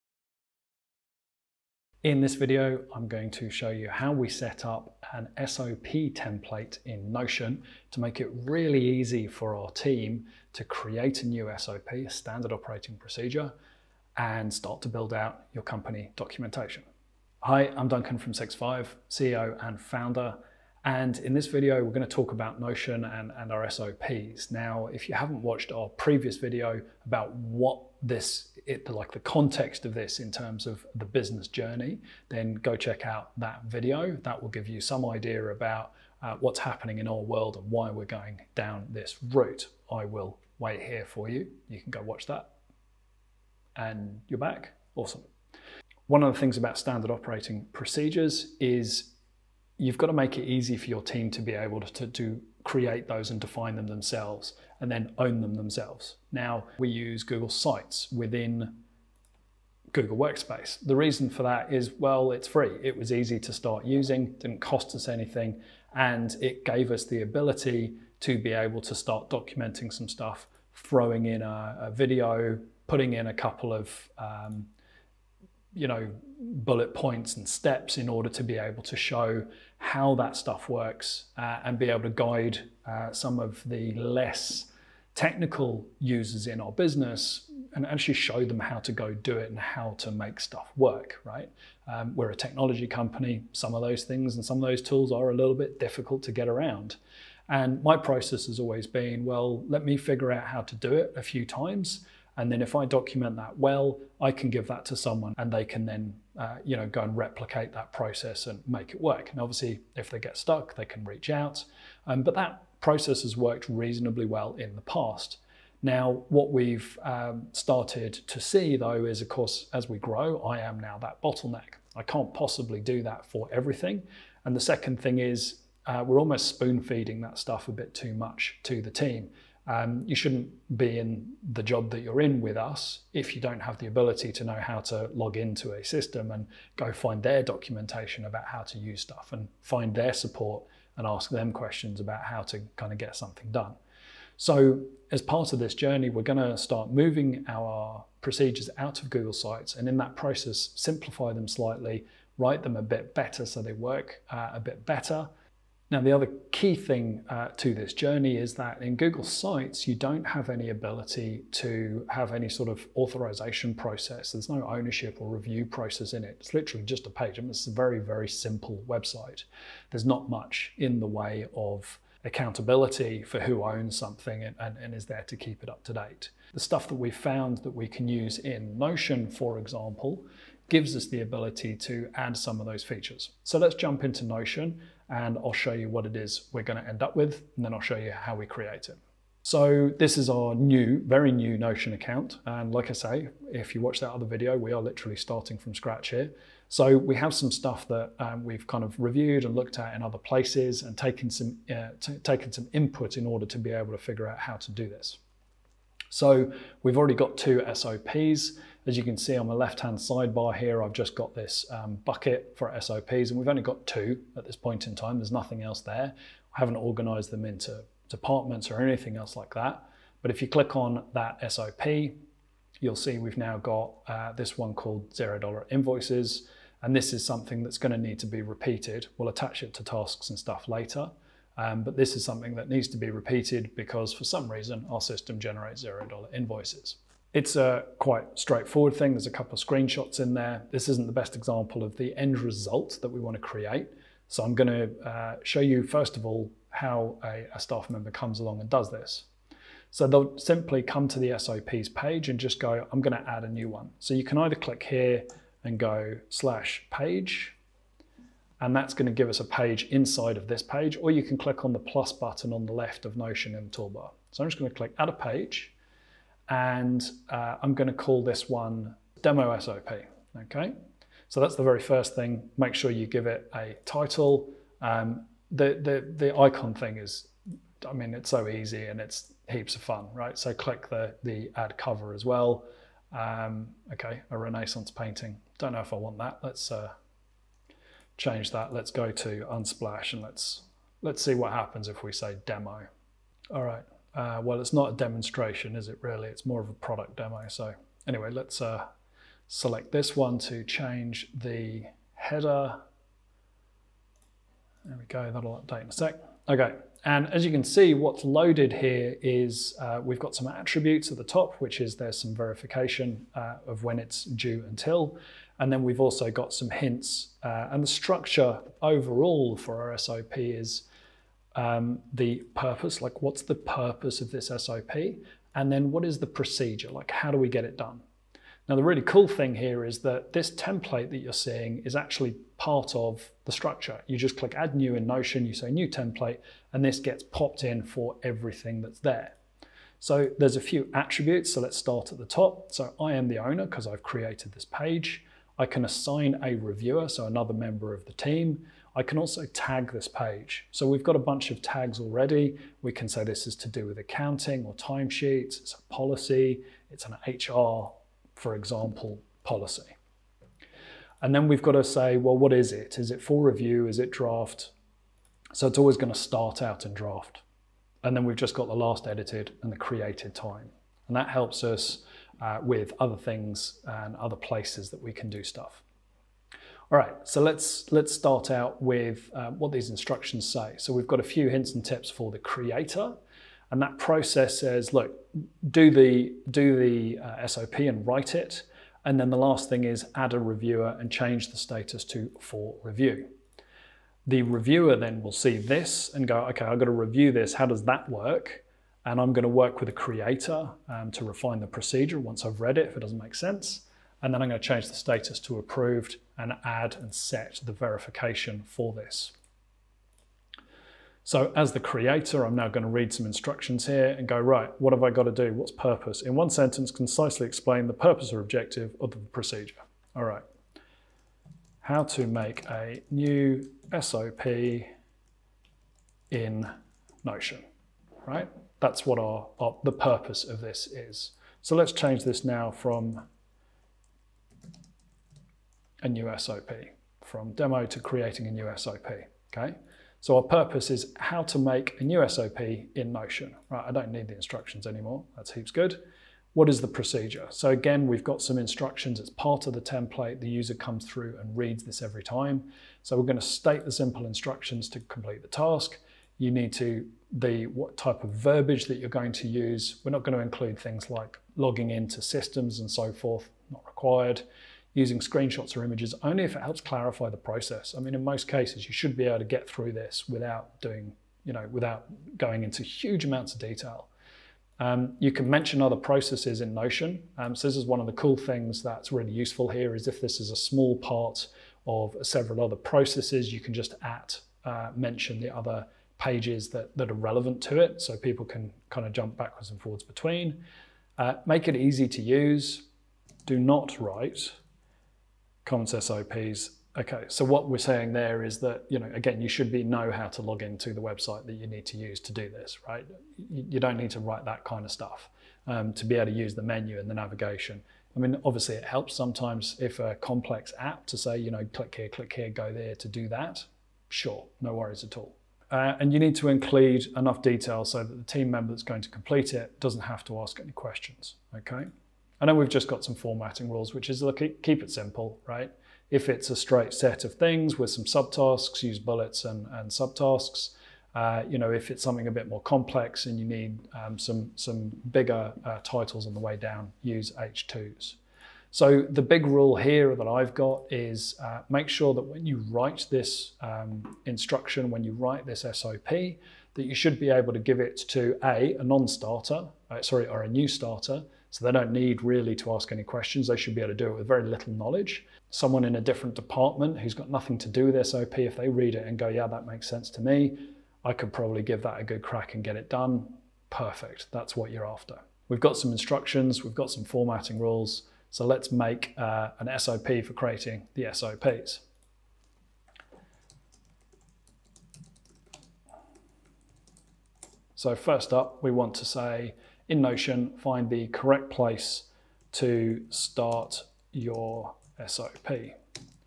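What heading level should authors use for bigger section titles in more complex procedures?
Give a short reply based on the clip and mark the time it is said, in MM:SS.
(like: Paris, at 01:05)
H2s, at 08:57.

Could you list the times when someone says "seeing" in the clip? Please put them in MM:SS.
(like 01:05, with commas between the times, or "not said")
05:31.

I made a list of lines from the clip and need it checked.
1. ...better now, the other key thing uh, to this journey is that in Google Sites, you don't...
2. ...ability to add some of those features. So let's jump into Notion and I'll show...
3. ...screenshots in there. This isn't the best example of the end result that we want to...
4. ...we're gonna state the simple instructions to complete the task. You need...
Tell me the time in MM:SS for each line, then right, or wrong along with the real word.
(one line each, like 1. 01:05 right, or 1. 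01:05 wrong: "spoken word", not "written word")
1. 02:34 right
2. 03:01 right
3. 03:59 right
4. 07:33 right.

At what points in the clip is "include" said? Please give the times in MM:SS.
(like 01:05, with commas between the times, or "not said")
07:40, 08:36.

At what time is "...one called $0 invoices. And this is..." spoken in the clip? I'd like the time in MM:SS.
03:44.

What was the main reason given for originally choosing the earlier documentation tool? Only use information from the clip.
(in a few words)
it's free.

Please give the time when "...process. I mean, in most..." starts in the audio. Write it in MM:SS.
07:47.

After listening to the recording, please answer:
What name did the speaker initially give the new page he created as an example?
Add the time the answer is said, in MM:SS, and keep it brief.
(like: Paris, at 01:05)
demo SOP, at 04:29.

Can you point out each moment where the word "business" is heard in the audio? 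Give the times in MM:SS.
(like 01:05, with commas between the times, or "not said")
00:31, 01:26.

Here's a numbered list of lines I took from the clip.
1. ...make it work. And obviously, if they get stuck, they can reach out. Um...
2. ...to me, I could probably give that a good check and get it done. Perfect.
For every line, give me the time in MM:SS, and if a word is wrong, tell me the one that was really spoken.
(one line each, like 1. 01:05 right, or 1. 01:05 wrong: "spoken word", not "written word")
1. 01:48 right
2. 09:20 wrong: "crack", not "check".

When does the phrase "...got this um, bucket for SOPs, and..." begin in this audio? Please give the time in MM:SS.
03:31.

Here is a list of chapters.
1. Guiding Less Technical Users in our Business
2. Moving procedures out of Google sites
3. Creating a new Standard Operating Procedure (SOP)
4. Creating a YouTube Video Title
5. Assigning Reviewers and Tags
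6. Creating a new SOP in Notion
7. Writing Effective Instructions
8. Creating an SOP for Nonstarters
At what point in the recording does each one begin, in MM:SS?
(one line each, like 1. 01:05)
1. 01:16
2. 02:23
3. 03:28
4. 04:31
5. 05:43
6. 06:52
7. 07:59
8. 09:04.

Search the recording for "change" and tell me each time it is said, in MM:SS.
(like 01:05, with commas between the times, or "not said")
04:48, 05:00, 06:31, 06:44, 07:11.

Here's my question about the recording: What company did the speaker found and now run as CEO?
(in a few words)
SixFive.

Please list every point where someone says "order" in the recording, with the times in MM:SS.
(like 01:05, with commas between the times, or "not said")
01:18, 03:23.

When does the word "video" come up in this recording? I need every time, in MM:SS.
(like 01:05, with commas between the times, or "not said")
00:02, 00:21, 00:26, 00:33, 01:11, 03:14.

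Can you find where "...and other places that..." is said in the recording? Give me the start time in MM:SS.
06:13.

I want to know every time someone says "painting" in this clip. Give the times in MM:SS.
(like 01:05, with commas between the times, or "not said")
04:44.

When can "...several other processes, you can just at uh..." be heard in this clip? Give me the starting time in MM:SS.
08:02.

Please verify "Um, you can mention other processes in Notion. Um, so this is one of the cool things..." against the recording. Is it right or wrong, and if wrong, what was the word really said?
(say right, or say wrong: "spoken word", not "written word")
right.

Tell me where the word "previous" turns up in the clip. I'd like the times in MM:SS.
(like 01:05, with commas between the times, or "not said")
00:25.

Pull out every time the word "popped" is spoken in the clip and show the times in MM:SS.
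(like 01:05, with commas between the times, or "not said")
05:37.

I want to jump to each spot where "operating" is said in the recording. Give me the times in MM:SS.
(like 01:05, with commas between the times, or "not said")
00:12, 00:47.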